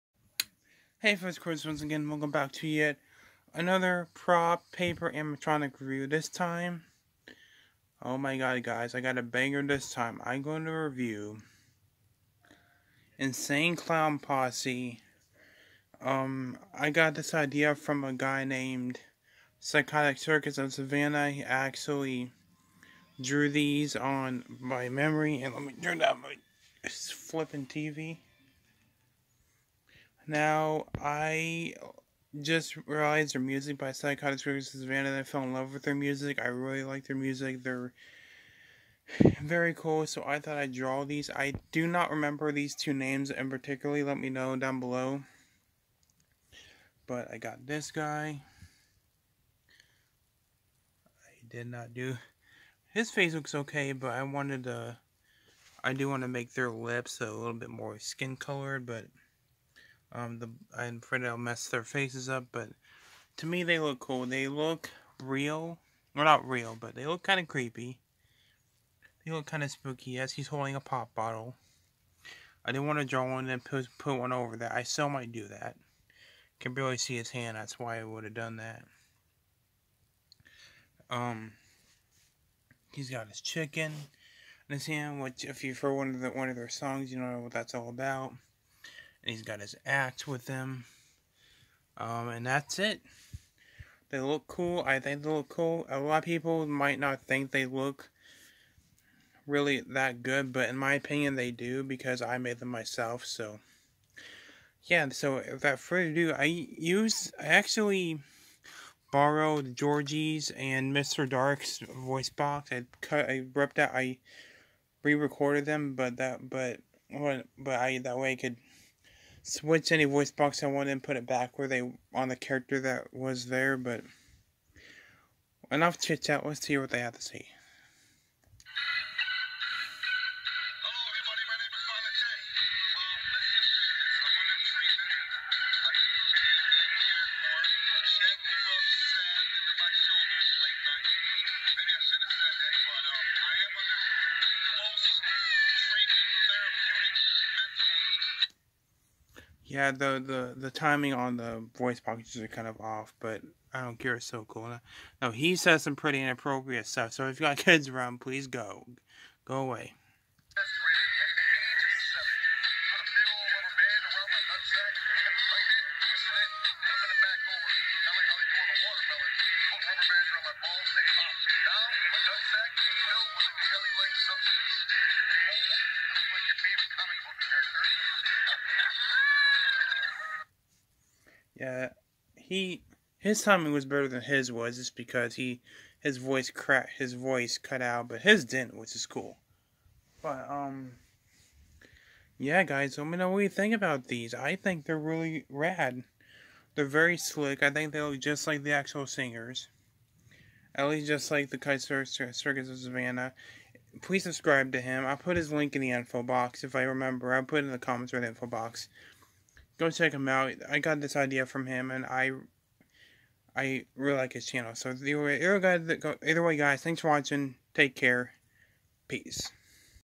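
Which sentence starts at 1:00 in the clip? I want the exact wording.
Um, the I'm afraid I'll mess their faces up, but to me they look cool.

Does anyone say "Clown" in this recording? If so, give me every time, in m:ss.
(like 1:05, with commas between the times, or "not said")
0:13.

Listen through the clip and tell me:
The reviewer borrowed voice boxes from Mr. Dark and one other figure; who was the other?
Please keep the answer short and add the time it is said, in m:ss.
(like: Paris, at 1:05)
Georgie, at 1:49.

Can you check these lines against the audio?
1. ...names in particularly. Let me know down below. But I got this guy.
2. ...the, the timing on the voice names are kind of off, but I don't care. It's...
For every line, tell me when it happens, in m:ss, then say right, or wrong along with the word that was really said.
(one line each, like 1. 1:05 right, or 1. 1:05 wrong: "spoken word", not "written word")
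1. 0:42 right
2. 2:30 wrong: "packages", not "names".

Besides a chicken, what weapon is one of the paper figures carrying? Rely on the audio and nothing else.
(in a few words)
Axe.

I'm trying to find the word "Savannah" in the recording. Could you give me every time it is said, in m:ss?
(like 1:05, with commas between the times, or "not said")
0:20, 3:22.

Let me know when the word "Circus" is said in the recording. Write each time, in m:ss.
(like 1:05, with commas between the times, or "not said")
0:20, 0:34, 3:22.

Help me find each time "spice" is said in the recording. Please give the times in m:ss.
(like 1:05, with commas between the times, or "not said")
not said.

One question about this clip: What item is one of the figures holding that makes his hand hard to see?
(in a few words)
Pop bottle.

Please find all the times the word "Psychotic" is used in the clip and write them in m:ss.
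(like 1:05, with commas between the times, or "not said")
0:19, 0:33, 3:21.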